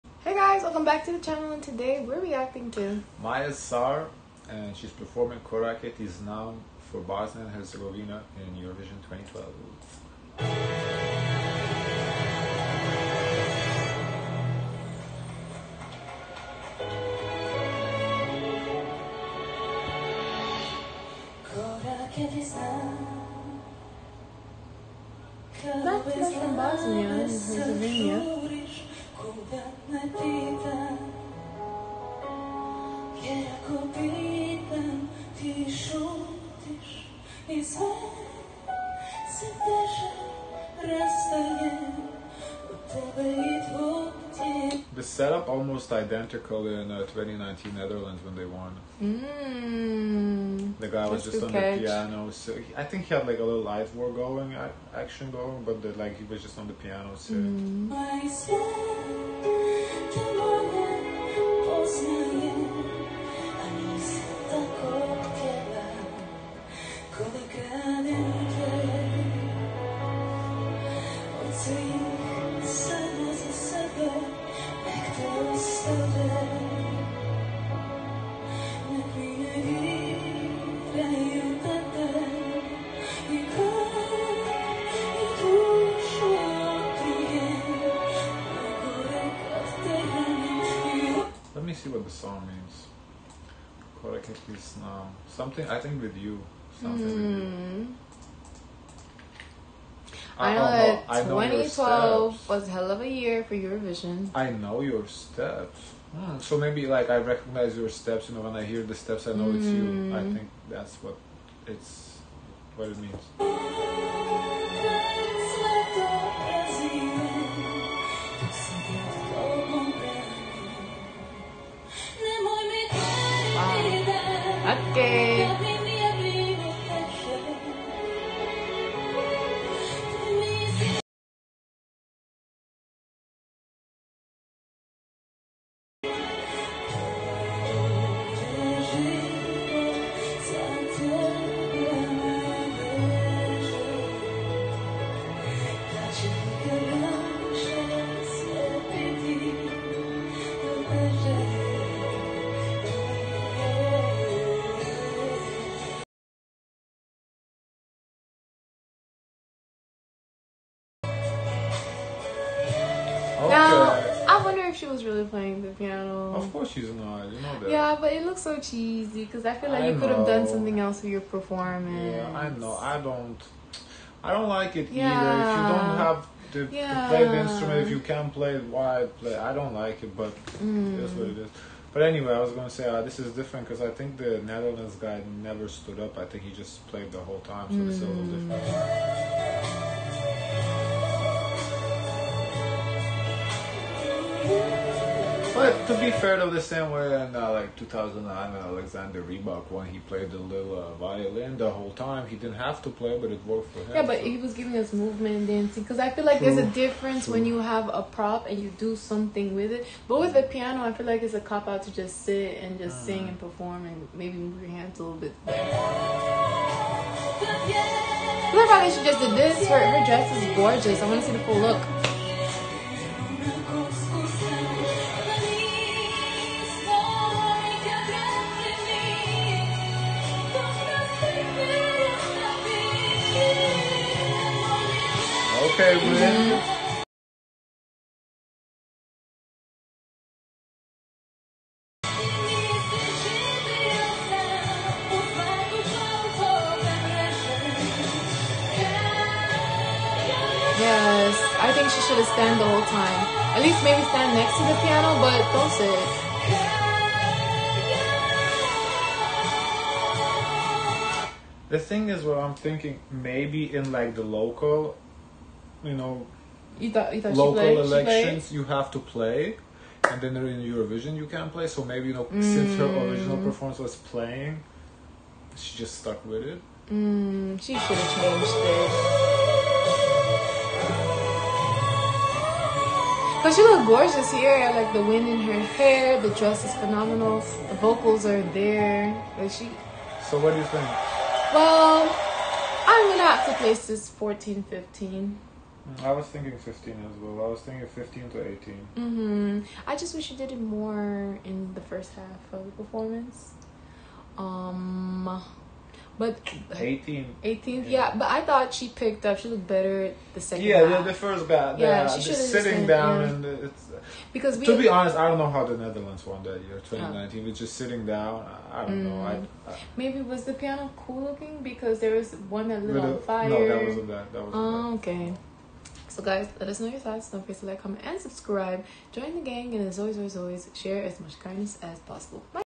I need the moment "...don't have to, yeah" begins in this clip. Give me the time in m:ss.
2:55.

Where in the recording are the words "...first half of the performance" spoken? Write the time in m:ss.
5:01.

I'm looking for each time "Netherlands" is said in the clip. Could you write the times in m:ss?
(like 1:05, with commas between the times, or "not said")
0:47, 3:04, 5:15.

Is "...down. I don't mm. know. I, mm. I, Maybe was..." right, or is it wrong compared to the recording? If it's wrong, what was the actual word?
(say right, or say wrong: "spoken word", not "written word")
right.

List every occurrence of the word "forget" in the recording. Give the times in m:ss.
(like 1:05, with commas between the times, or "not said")
5:27.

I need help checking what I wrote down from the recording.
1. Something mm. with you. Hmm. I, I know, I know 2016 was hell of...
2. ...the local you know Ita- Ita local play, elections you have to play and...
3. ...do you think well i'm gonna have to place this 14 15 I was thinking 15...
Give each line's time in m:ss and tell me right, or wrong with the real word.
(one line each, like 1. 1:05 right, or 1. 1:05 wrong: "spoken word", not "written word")
1. 1:36 wrong: "2012", not "2016"
2. 4:24 right
3. 4:50 right.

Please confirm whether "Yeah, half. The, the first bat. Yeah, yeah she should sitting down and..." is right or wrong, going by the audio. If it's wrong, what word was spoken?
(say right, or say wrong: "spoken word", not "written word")
right.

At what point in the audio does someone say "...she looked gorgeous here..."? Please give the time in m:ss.
4:43.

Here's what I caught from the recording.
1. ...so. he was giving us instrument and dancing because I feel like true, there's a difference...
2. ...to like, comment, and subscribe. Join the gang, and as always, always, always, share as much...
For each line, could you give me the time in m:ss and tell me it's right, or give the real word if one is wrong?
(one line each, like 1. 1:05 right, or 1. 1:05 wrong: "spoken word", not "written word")
1. 3:24 wrong: "movement", not "instrument"
2. 5:27 right.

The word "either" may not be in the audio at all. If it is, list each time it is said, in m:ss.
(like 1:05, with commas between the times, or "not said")
2:55.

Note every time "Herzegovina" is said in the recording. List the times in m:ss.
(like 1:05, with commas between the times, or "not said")
0:07, 0:27.